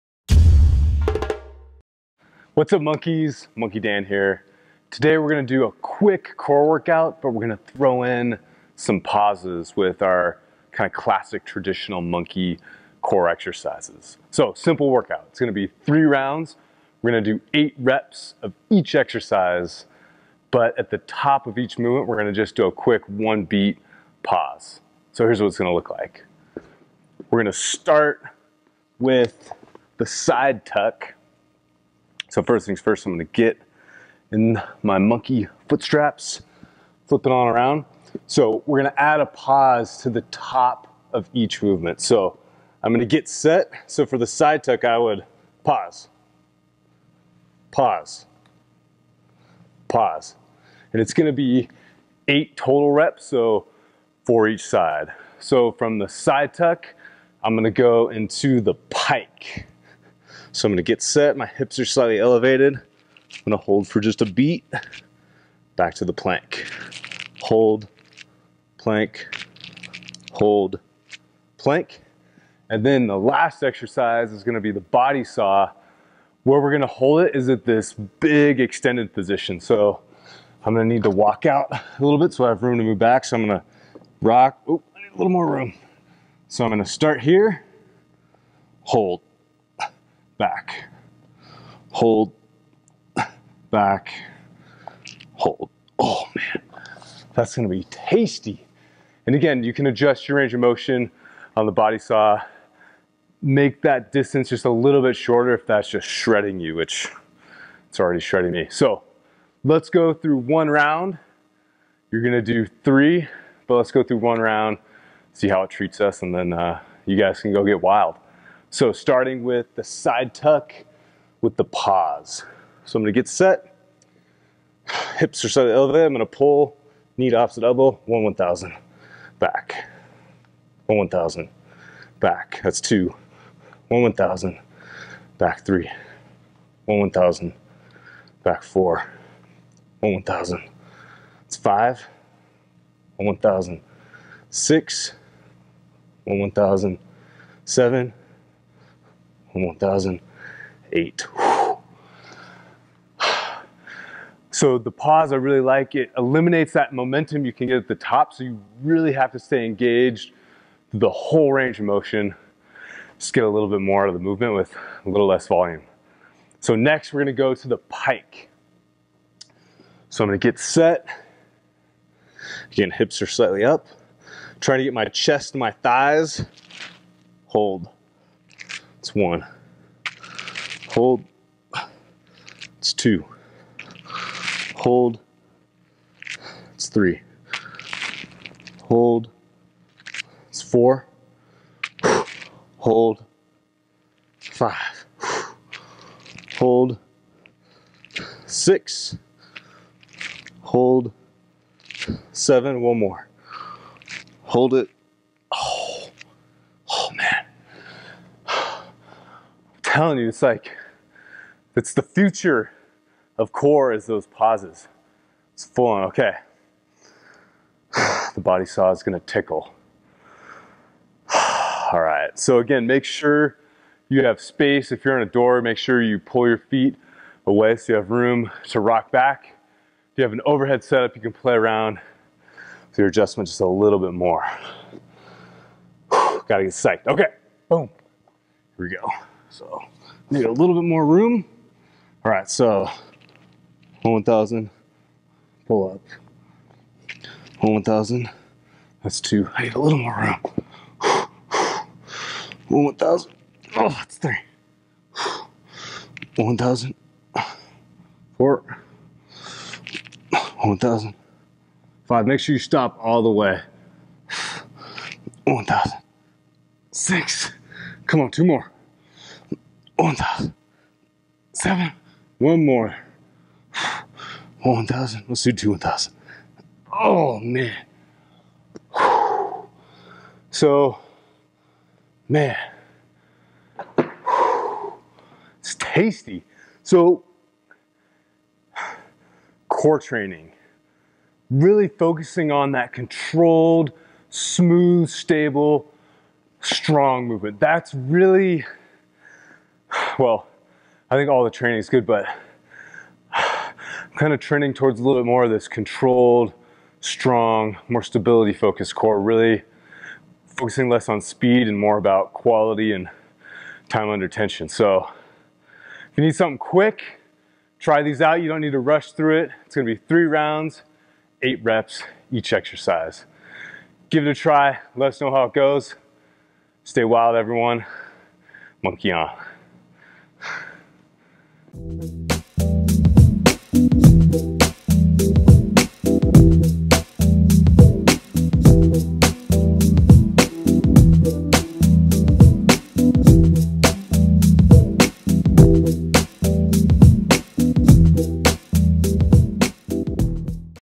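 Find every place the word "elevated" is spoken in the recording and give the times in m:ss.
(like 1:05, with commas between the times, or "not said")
1:02, 2:05.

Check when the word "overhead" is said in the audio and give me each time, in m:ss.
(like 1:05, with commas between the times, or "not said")
3:50.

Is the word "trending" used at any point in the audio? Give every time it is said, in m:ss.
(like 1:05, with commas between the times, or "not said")
5:04.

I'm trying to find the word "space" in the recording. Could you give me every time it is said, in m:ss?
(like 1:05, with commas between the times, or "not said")
3:44.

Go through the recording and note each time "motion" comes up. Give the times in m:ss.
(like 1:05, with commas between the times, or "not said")
1:40, 2:41.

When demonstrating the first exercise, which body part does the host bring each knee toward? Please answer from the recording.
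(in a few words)
Opposite elbow.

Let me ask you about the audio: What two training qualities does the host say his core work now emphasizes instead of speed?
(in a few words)
Quality and time under tension.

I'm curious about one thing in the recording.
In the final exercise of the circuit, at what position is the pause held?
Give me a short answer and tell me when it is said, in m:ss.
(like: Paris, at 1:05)
Big extended position, at 1:17.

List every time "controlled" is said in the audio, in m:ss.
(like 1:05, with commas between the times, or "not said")
4:52, 5:05.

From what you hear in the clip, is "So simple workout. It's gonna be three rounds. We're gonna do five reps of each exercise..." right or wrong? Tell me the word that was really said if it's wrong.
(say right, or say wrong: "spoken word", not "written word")
wrong: "eight", not "five".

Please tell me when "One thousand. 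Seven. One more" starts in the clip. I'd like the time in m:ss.
4:30.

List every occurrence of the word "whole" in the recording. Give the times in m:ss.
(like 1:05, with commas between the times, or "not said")
2:41.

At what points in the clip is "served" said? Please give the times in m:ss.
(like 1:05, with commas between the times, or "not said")
not said.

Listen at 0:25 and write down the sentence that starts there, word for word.
So here's what it's gonna look like.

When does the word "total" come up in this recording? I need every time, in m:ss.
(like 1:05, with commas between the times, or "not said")
0:52.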